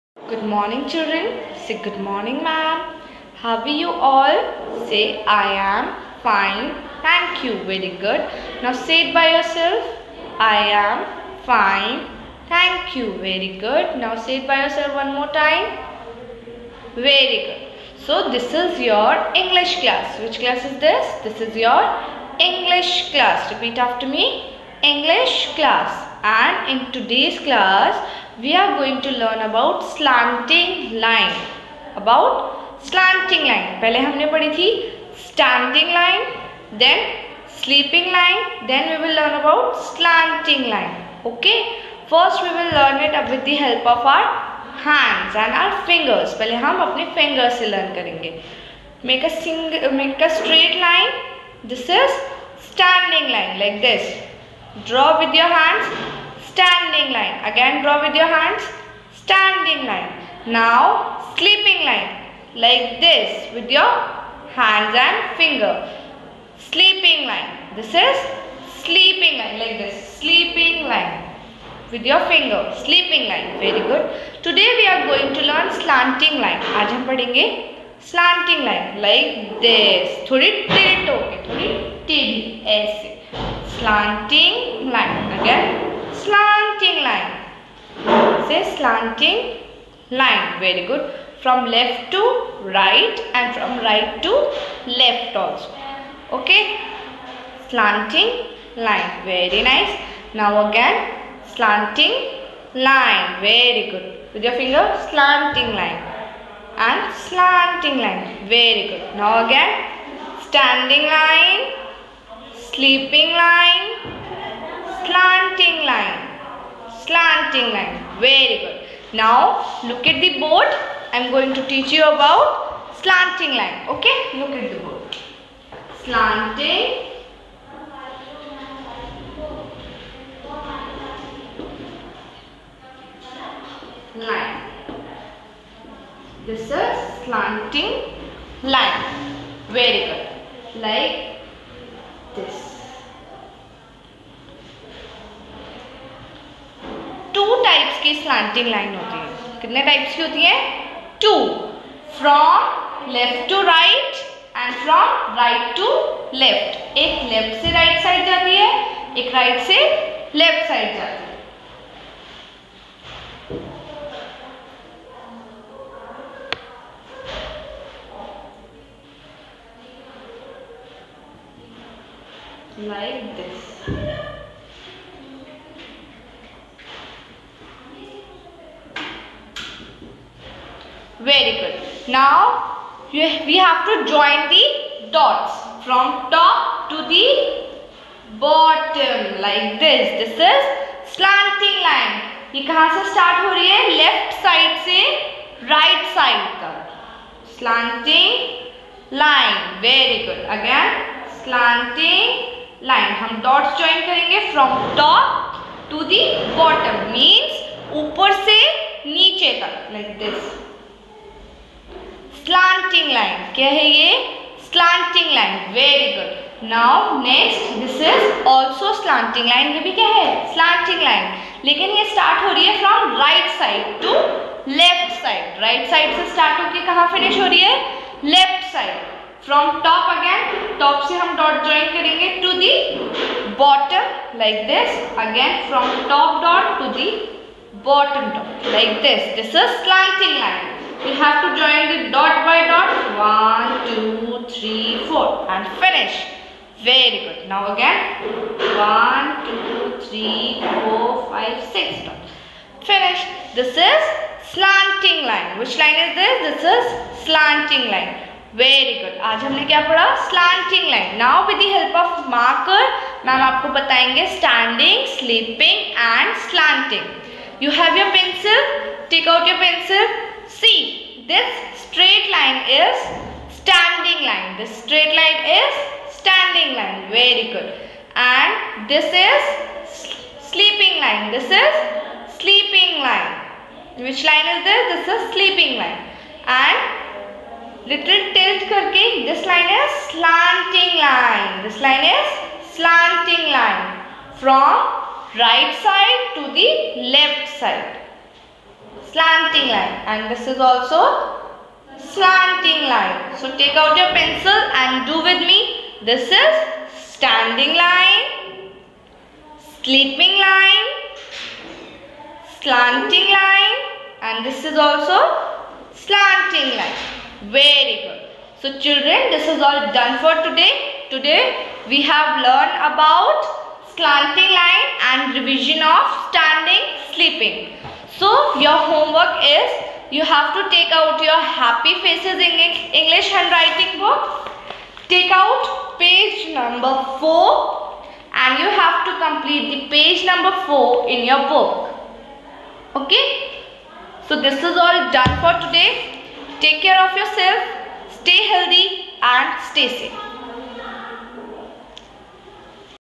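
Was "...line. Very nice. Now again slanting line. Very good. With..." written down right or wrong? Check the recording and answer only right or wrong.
right.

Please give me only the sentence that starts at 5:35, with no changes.
Take out page number 4 and you have to complete the page number 4 in your book.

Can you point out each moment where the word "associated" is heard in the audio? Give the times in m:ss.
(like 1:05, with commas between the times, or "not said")
not said.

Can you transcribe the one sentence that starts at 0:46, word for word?
पहले हम अपने fingers से learn करेंगे.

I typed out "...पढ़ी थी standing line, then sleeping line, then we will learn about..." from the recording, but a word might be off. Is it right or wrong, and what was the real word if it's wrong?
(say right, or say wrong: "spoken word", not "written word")
right.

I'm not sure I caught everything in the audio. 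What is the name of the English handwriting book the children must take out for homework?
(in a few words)
Happy Faces.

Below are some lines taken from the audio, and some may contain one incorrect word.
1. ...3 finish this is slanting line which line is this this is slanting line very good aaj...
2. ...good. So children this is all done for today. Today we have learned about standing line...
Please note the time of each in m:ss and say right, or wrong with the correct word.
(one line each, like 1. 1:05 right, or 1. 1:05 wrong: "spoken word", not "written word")
1. 4:12 wrong: "2", not "3"
2. 5:18 wrong: "slanting", not "standing".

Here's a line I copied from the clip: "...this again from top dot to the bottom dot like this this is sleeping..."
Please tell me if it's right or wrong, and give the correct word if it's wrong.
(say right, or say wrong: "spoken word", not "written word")
wrong: "slanting", not "sleeping".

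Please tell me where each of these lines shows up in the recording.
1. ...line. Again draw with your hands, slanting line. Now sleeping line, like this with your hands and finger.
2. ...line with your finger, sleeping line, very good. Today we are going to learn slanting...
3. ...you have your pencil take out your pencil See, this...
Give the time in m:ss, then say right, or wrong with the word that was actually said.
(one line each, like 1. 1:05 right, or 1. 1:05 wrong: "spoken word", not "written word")
1. 0:57 wrong: "standing", not "slanting"
2. 1:10 right
3. 4:27 right.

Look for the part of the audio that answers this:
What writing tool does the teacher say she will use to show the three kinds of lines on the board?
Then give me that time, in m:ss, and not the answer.
4:22.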